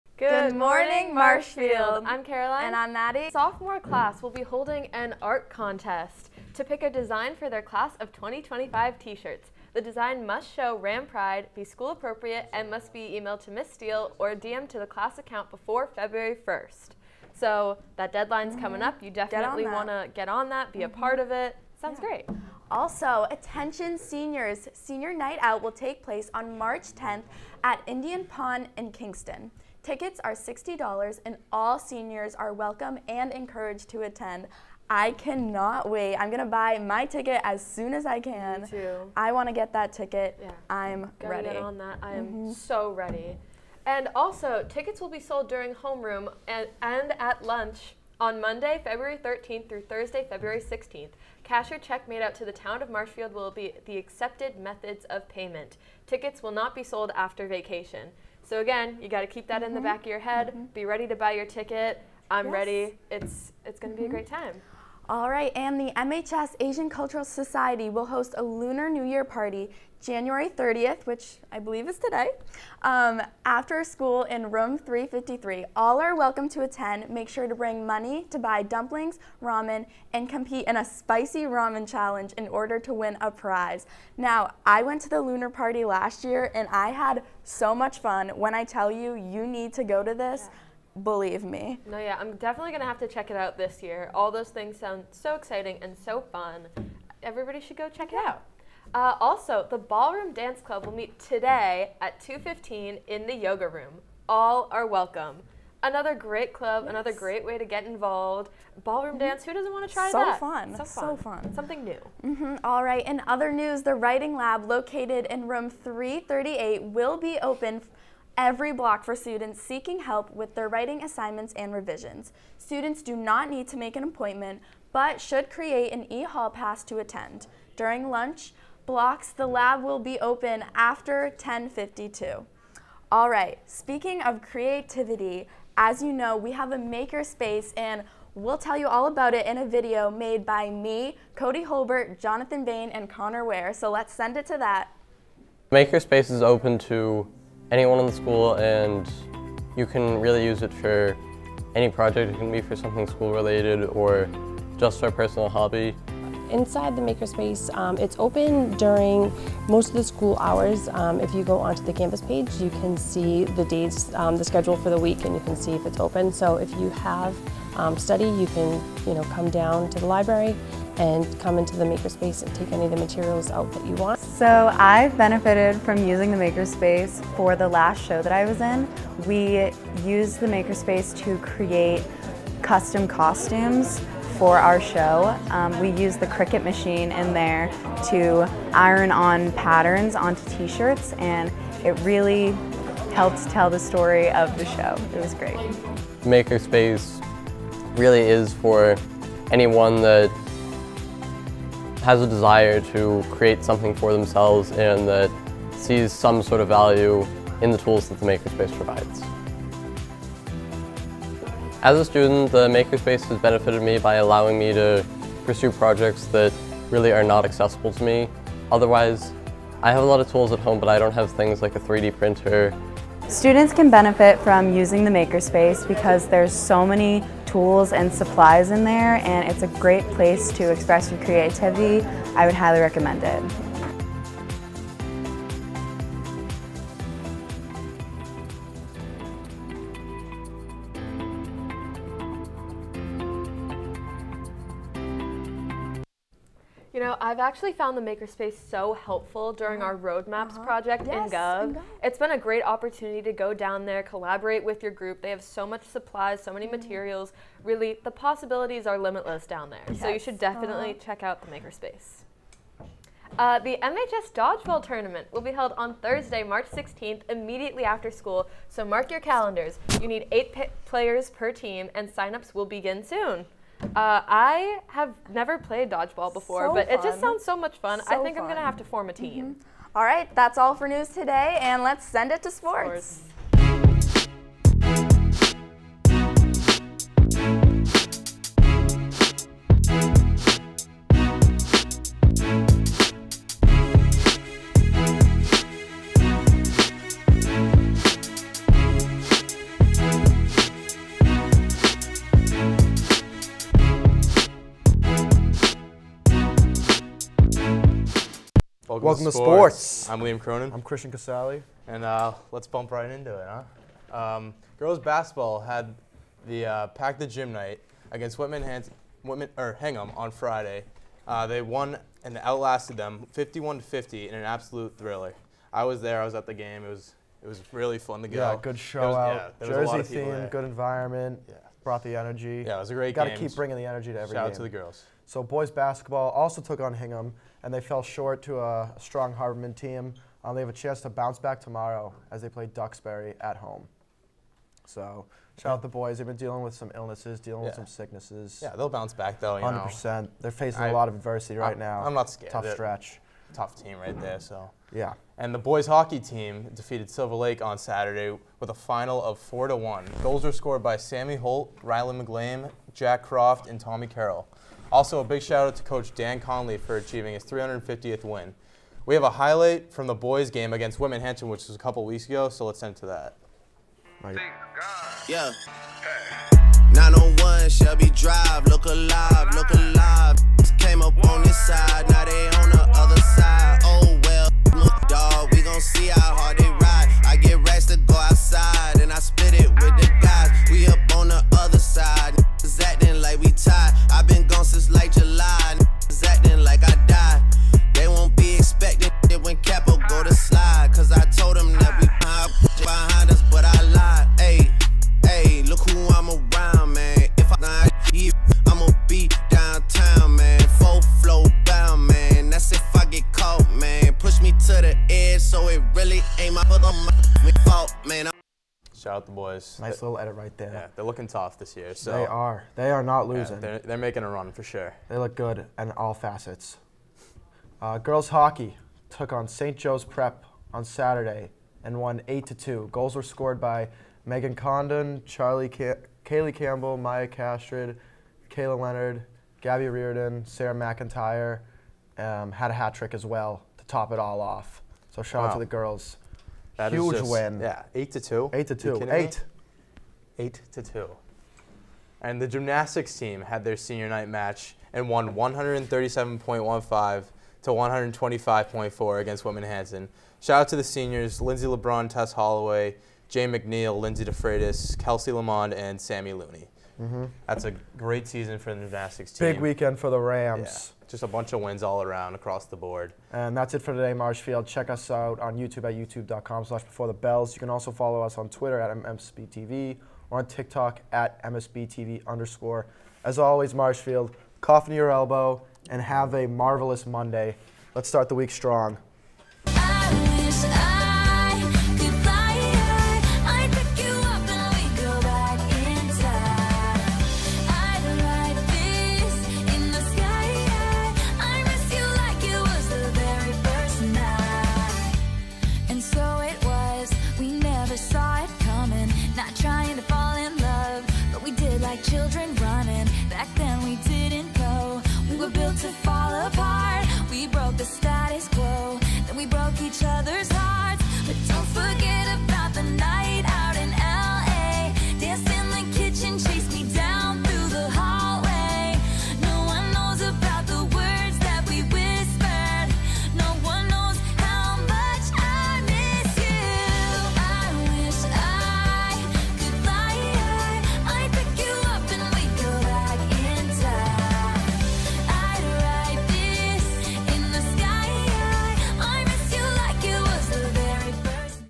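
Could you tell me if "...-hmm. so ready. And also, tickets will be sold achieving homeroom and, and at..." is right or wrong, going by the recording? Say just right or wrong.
wrong.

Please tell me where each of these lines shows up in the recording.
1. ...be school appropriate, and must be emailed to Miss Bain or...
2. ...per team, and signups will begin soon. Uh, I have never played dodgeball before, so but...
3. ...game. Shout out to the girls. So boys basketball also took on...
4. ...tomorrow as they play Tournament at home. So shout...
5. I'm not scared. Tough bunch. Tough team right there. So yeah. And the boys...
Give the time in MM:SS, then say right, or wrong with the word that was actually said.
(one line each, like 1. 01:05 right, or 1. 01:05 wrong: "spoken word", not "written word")
1. 00:11 wrong: "Steele", not "Bain"
2. 04:31 right
3. 05:34 right
4. 05:41 wrong: "Duxbury", not "Tournament"
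5. 05:52 wrong: "stretch", not "bunch".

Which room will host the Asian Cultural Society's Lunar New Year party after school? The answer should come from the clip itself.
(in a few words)
Room 353.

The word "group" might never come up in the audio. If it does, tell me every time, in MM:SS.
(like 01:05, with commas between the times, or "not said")
04:14.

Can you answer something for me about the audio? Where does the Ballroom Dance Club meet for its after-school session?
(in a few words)
The yoga room.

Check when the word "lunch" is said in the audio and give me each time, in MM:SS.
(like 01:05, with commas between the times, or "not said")
00:47, 02:08.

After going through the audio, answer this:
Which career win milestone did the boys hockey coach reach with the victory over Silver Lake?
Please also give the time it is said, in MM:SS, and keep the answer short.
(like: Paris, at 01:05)
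350th win, at 06:07.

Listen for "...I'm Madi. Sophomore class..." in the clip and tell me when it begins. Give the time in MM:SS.
00:02.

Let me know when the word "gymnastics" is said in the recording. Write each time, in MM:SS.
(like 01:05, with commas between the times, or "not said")
07:32, 07:48.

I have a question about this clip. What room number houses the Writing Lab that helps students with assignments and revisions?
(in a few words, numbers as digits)
338.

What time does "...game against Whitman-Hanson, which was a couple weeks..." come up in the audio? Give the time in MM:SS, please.
06:10.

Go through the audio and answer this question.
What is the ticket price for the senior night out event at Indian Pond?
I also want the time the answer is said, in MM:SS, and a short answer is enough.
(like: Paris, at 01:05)
$60, at 00:30.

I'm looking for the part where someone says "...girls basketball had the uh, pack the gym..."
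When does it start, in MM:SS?
05:14.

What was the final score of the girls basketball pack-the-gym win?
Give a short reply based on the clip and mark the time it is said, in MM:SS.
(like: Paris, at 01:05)
51 to 50, at 05:23.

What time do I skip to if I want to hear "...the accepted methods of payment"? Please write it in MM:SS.
00:53.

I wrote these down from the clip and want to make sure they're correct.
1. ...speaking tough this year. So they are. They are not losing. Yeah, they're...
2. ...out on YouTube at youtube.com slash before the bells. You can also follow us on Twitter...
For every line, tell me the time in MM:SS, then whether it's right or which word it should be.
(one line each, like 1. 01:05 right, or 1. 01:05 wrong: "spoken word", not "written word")
1. 07:01 wrong: "looking", not "speaking"
2. 07:55 right.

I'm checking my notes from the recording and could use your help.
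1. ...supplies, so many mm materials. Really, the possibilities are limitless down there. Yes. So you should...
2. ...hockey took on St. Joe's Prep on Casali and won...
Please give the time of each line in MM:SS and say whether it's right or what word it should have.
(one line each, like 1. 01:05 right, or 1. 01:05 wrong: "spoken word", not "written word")
1. 04:15 right
2. 07:08 wrong: "Saturday", not "Casali".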